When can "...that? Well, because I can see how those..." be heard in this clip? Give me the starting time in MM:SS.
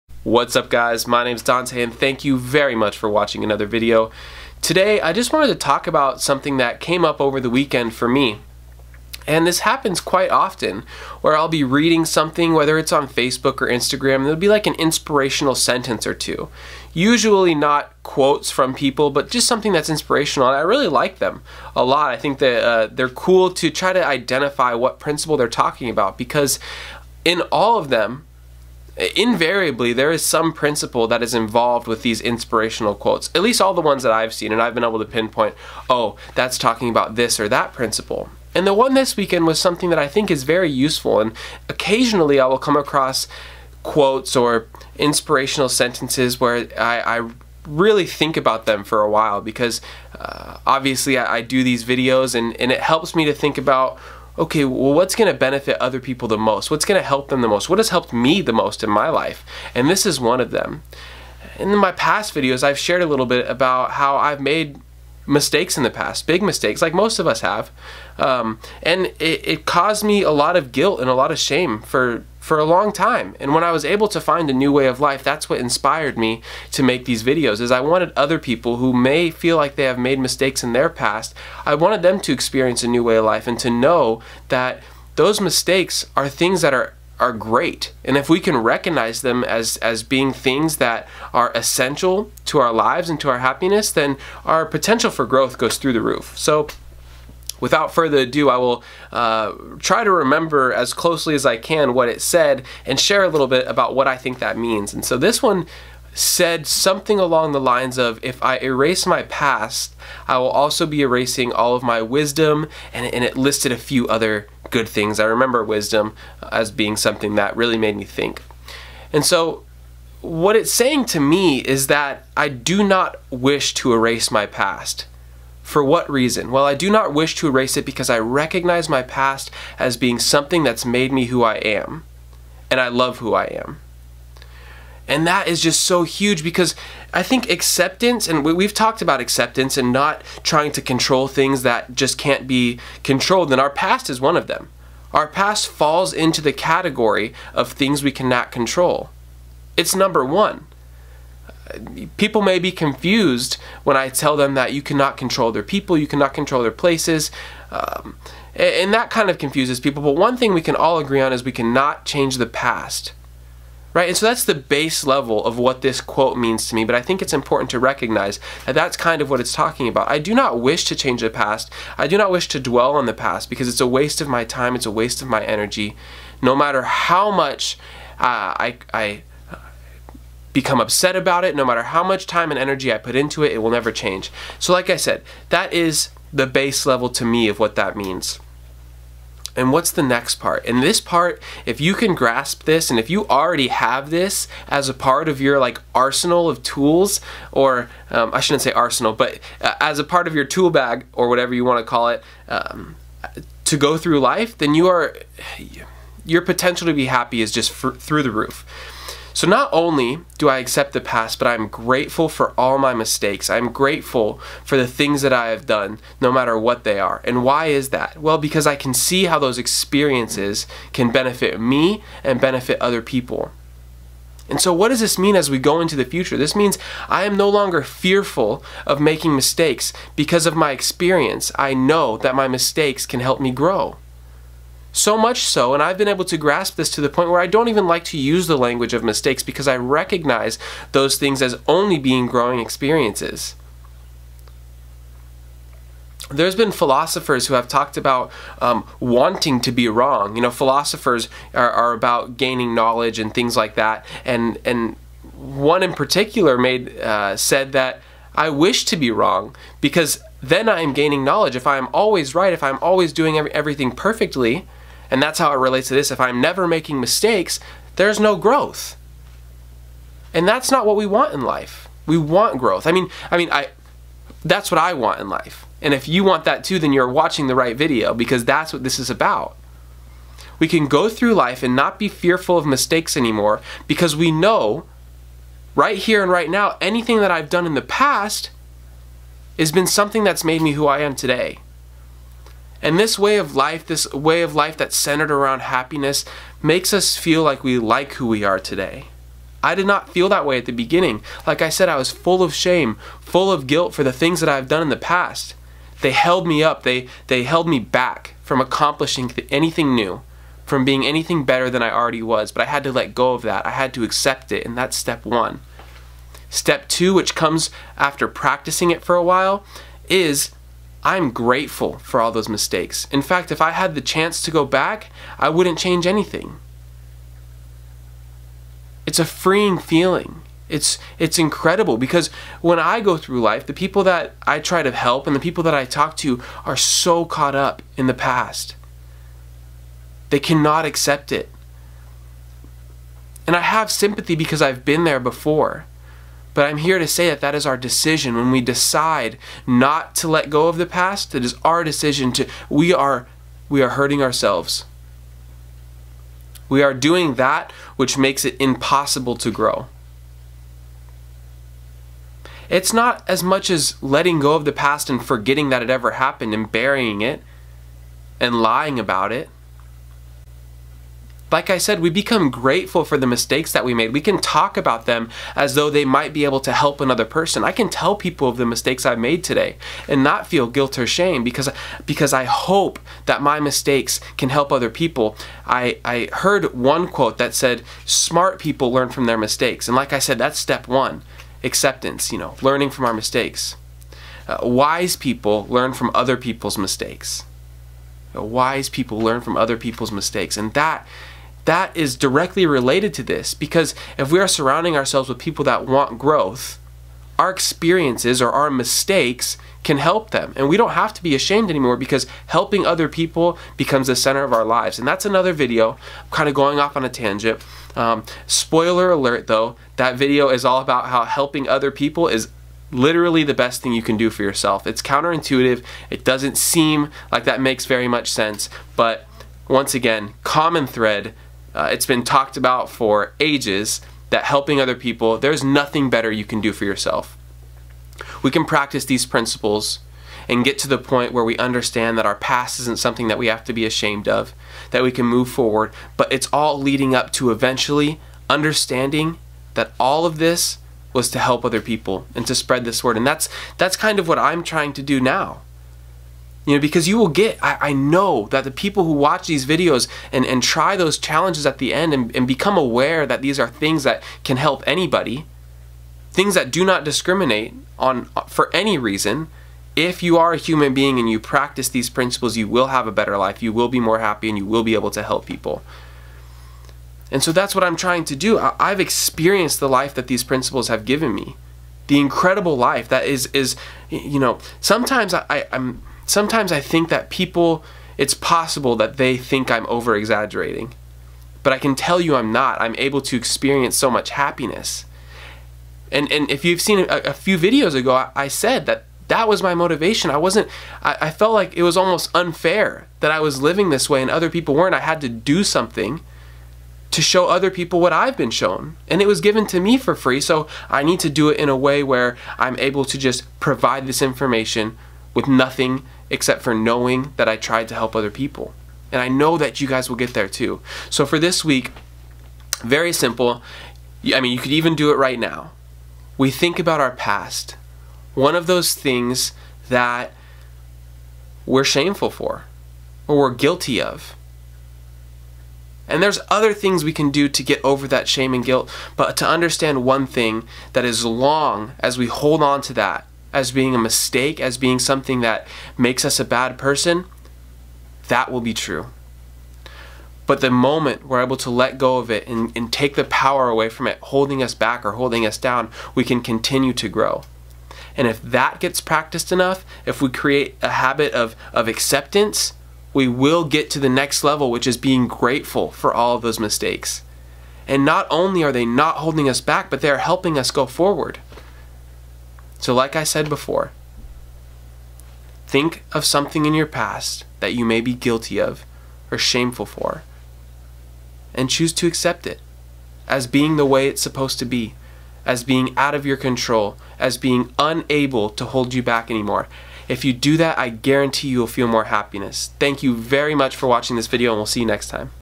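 03:37.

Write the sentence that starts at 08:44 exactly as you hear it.
I mean, you could even do it right now.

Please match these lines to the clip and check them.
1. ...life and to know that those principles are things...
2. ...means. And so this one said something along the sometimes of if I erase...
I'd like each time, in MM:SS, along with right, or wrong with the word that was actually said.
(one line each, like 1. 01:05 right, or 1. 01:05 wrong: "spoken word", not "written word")
1. 01:23 wrong: "mistakes", not "principles"
2. 01:44 wrong: "lines", not "sometimes".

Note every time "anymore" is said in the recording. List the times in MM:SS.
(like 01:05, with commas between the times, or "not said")
04:43, 06:51, 09:49.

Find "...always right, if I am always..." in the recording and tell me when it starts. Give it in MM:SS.
04:21.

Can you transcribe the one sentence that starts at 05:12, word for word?
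But I had to let go of that, I had to accept it, and that's step one.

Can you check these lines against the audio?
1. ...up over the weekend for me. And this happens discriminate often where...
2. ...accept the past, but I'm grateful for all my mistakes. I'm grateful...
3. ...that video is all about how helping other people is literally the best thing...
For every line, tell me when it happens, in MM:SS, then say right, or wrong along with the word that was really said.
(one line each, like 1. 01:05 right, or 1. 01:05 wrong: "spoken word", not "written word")
1. 00:07 wrong: "quite", not "discriminate"
2. 03:30 right
3. 06:59 right.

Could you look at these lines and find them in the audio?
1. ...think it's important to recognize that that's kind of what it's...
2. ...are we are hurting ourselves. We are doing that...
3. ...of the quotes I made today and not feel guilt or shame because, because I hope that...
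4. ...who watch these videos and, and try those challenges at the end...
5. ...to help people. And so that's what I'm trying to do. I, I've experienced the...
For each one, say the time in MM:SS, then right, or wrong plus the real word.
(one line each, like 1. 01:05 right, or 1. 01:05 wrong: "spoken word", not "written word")
1. 02:47 right
2. 05:52 right
3. 06:18 wrong: "mistakes", not "quotes"
4. 07:39 right
5. 07:55 right.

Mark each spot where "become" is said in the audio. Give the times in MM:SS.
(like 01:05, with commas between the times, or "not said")
03:00, 06:12, 06:53, 07:42.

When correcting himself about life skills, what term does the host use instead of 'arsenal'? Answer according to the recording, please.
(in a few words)
tool bag.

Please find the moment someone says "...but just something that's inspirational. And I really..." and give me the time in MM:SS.
00:19.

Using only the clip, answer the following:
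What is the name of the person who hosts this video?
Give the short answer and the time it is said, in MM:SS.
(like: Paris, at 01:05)
Dante, at 00:01.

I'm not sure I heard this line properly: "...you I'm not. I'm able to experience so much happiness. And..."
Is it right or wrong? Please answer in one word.
right.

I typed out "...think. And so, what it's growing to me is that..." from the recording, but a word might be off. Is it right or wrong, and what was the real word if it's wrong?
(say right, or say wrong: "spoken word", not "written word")
wrong: "saying", not "growing".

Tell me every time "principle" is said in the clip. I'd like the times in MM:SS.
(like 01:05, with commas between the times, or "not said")
00:24, 00:30, 00:37, 07:19, 07:52, 08:00.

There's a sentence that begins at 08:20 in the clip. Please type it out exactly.
I wasn't, I, I felt like it was almost unfair that I was living this way and other people weren't.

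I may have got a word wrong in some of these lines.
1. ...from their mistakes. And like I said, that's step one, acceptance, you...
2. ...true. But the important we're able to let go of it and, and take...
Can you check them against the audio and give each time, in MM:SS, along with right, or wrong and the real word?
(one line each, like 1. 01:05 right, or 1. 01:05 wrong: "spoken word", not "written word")
1. 06:29 right
2. 09:08 wrong: "moment", not "important".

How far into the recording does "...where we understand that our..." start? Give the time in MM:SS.
07:21.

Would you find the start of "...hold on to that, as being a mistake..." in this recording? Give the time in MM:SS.
09:02.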